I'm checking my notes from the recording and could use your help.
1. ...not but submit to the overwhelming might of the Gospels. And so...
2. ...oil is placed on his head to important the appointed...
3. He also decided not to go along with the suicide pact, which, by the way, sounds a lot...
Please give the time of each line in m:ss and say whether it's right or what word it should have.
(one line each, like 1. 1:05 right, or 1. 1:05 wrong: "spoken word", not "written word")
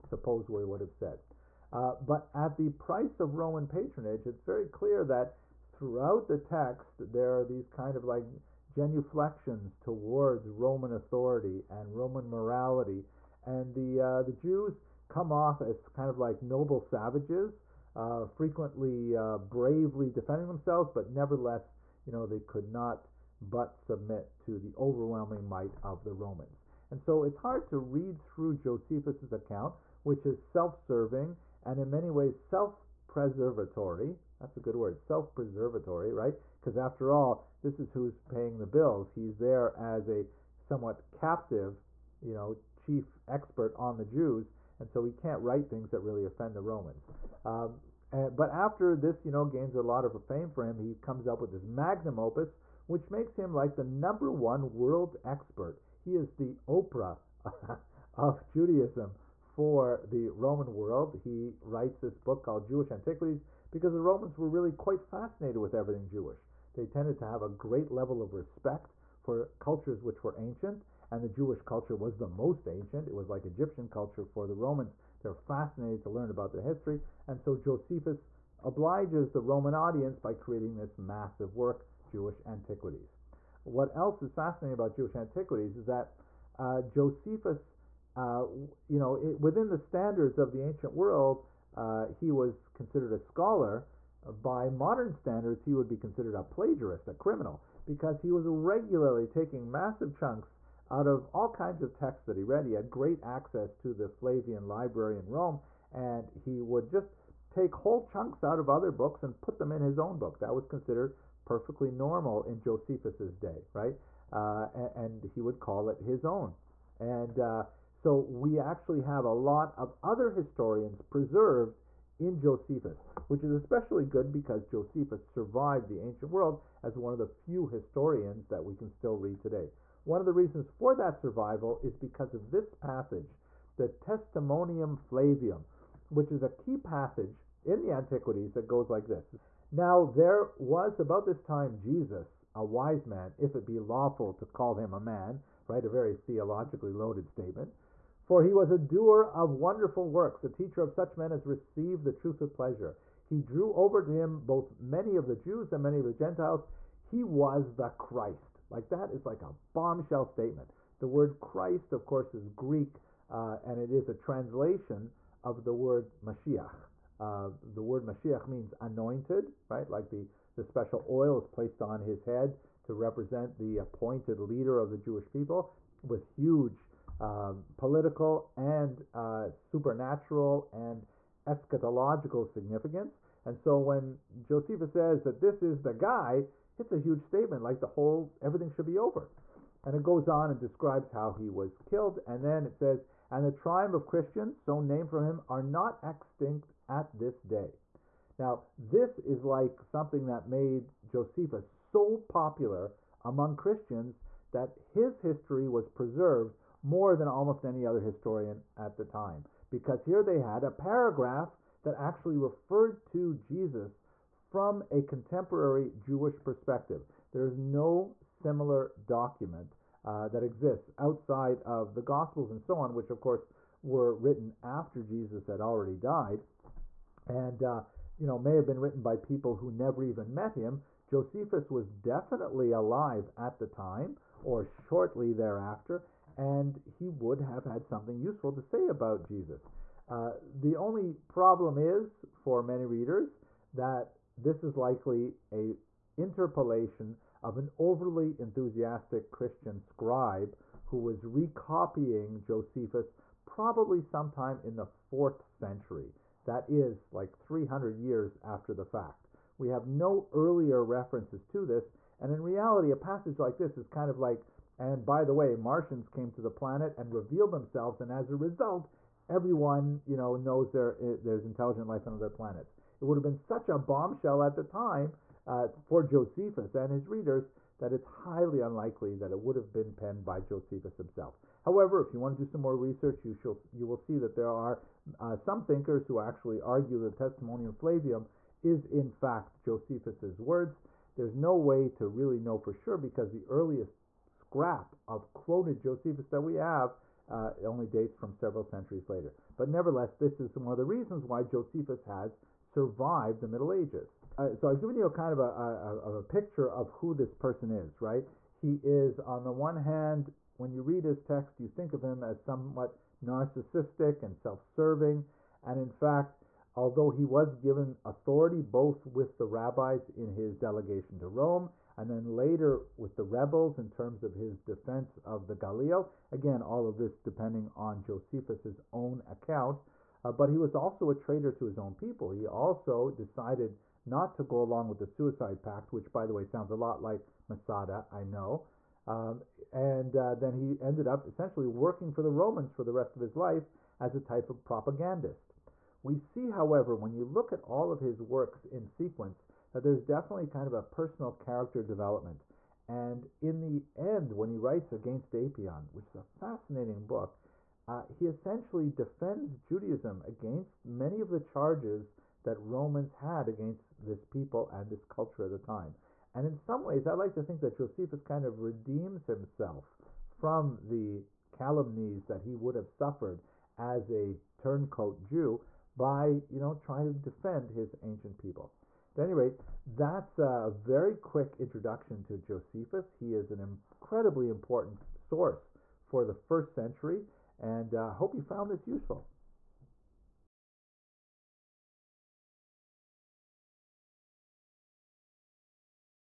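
1. 0:22 wrong: "Romans", not "Gospels"
2. 2:51 wrong: "represent", not "important"
3. 5:32 right.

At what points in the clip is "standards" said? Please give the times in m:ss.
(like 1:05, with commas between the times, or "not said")
1:29, 1:35.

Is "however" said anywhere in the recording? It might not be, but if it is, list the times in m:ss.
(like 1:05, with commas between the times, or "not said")
4:41, 5:46.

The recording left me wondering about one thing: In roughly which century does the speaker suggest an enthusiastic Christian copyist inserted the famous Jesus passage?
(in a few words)
4th century.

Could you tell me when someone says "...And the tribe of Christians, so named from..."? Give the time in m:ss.
3:13.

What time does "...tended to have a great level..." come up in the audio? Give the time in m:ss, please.
1:06.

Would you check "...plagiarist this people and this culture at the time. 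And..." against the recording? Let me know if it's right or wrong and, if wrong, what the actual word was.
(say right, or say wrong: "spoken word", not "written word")
wrong: "against", not "plagiarist".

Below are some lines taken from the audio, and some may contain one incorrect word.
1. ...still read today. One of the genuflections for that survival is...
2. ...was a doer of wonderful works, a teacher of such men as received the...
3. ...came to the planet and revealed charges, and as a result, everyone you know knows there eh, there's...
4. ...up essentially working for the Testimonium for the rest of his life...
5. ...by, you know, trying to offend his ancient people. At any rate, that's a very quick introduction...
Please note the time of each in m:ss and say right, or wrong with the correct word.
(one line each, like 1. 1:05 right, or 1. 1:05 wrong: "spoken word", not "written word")
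1. 2:08 wrong: "reasons", not "genuflections"
2. 2:28 right
3. 4:26 wrong: "themselves", not "charges"
4. 5:41 wrong: "Romans", not "Testimonium"
5. 6:16 wrong: "defend", not "offend".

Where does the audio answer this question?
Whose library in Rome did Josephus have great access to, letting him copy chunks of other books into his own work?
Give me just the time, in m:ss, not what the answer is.
1:44.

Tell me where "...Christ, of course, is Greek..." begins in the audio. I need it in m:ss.
2:41.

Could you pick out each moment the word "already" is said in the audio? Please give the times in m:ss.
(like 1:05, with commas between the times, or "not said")
3:45.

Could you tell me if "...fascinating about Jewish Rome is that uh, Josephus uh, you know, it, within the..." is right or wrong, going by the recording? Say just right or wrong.
wrong.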